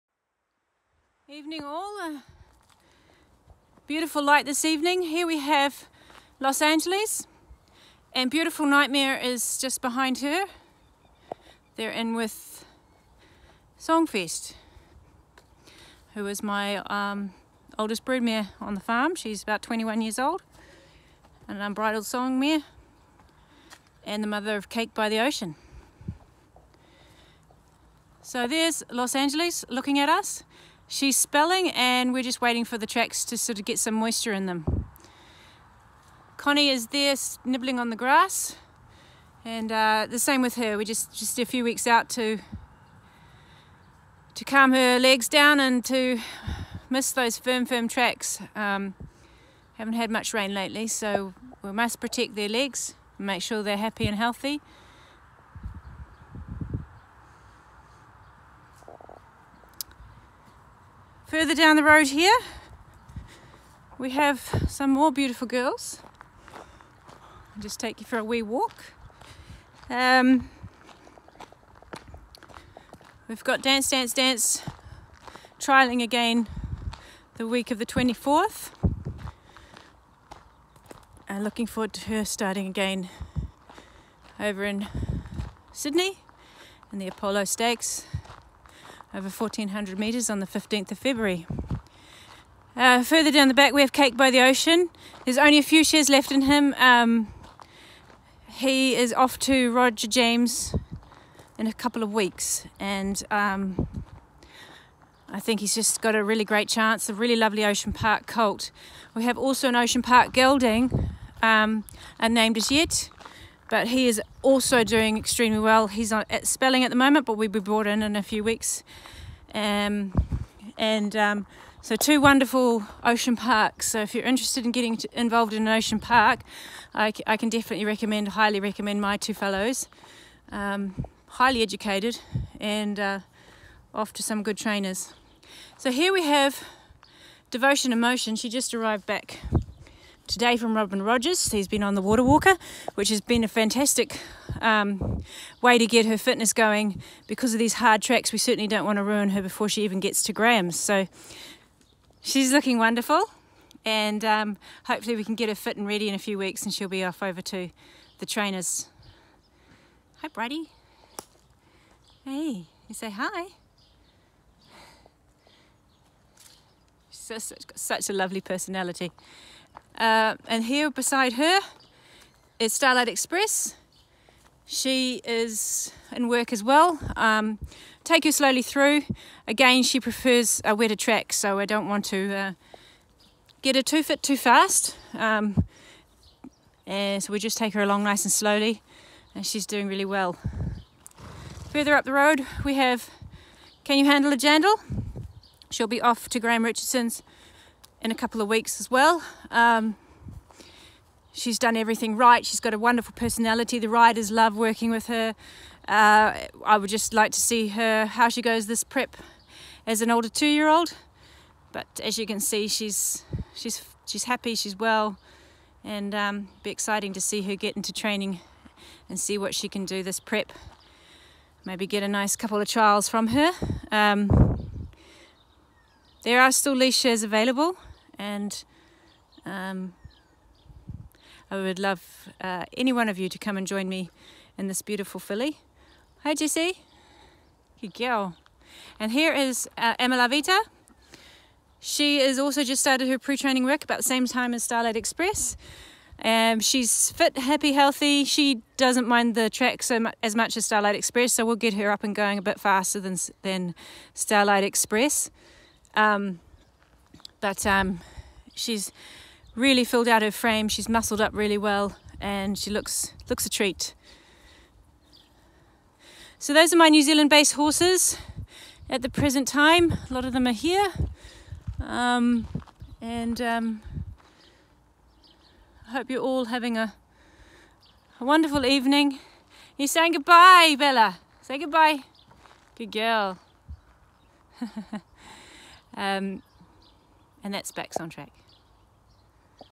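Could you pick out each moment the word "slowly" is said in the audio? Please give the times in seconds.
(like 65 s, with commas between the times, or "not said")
178 s, 188 s.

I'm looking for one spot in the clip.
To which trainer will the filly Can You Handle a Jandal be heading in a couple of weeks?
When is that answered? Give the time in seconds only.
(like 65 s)
196 s.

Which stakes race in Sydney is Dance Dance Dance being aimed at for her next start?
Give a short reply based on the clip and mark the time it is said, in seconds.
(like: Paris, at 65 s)
Apollo Stakes, at 87 s.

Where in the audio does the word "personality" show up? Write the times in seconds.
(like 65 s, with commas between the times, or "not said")
168 s, 203 s.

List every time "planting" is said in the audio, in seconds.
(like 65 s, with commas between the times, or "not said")
not said.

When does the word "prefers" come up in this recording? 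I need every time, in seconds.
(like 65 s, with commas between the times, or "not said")
179 s.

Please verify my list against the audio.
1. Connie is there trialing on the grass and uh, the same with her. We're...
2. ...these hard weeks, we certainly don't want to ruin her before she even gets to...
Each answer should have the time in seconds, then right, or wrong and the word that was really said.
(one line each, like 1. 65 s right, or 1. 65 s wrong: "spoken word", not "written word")
1. 36 s wrong: "nibbling", not "trialing"
2. 147 s wrong: "tracks", not "weeks".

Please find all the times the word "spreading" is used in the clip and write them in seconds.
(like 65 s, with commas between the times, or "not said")
not said.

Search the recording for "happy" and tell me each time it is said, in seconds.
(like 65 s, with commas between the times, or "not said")
53 s, 214 s, 247 s.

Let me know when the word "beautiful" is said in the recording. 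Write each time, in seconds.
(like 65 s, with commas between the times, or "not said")
3 s, 8 s, 65 s, 234 s.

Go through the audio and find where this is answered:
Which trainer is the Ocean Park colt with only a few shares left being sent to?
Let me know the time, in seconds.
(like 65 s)
99 s.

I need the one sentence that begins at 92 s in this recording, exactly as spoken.
Uh, further down the back, we have Cake by the Ocean.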